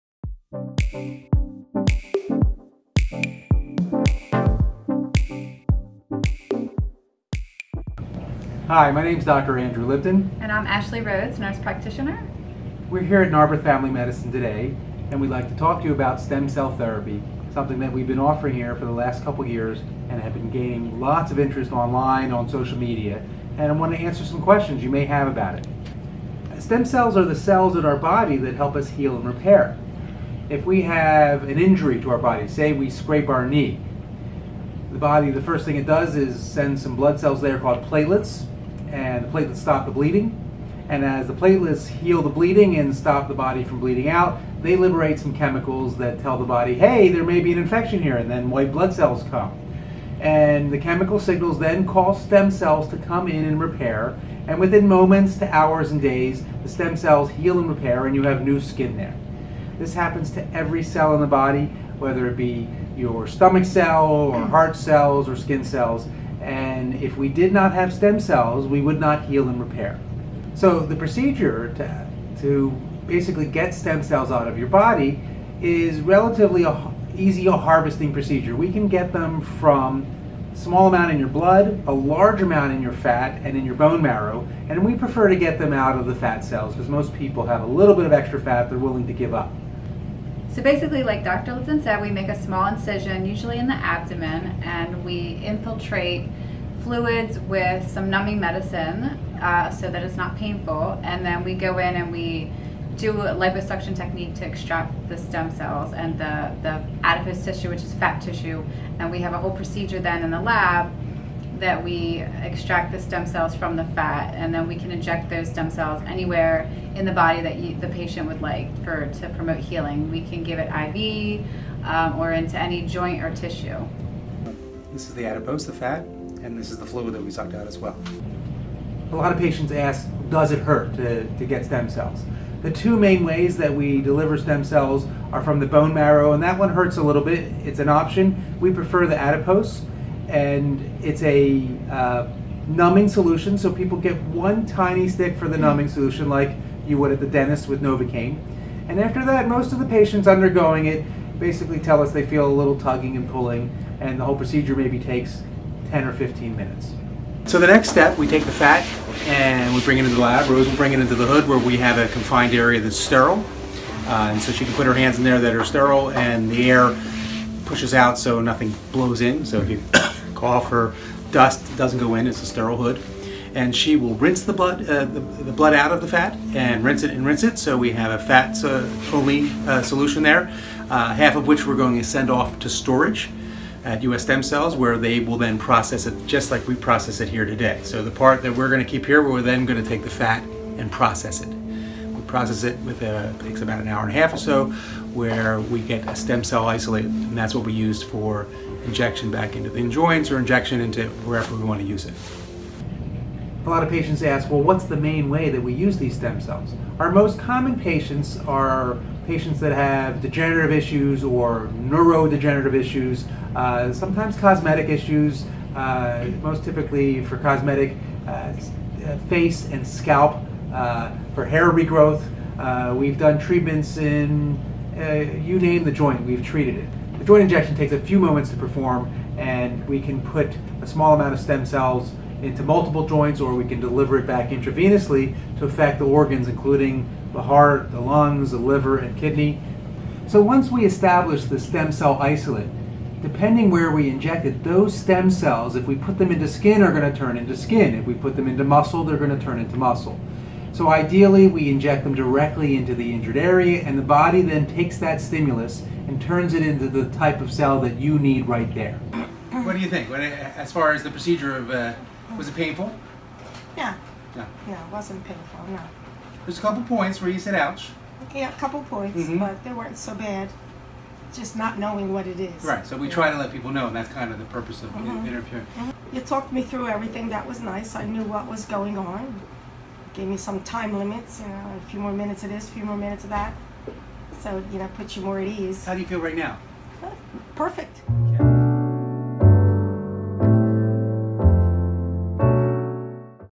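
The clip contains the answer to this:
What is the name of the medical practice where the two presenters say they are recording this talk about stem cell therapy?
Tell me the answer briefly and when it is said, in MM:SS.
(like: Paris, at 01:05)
Narberth Family Medicine, at 00:13.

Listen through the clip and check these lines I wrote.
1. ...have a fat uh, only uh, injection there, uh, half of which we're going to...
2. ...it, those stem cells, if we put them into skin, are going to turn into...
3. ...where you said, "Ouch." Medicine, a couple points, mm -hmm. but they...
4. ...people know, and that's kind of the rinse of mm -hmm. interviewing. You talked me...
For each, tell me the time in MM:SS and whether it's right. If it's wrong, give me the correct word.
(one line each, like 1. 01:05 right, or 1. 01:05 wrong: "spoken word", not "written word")
1. 02:57 wrong: "solution", not "injection"
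2. 04:04 right
3. 04:27 wrong: "Yeah", not "Medicine"
4. 04:33 wrong: "purpose", not "rinse".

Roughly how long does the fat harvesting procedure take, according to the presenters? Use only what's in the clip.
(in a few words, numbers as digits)
10 or 15 minutes.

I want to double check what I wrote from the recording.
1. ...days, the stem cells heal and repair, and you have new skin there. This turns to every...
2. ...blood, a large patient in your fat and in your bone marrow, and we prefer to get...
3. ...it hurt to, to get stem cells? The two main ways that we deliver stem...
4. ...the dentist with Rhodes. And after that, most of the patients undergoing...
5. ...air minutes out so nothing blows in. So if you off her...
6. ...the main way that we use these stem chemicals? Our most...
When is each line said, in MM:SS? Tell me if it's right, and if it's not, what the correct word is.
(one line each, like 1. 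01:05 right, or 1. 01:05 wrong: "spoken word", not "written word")
1. 00:56 wrong: "happens", not "turns"
2. 01:21 wrong: "amount", not "patient"
3. 02:10 right
4. 02:27 wrong: "Novocaine", not "Rhodes"
5. 02:46 wrong: "pushes", not "minutes"
6. 03:24 wrong: "cells", not "chemicals".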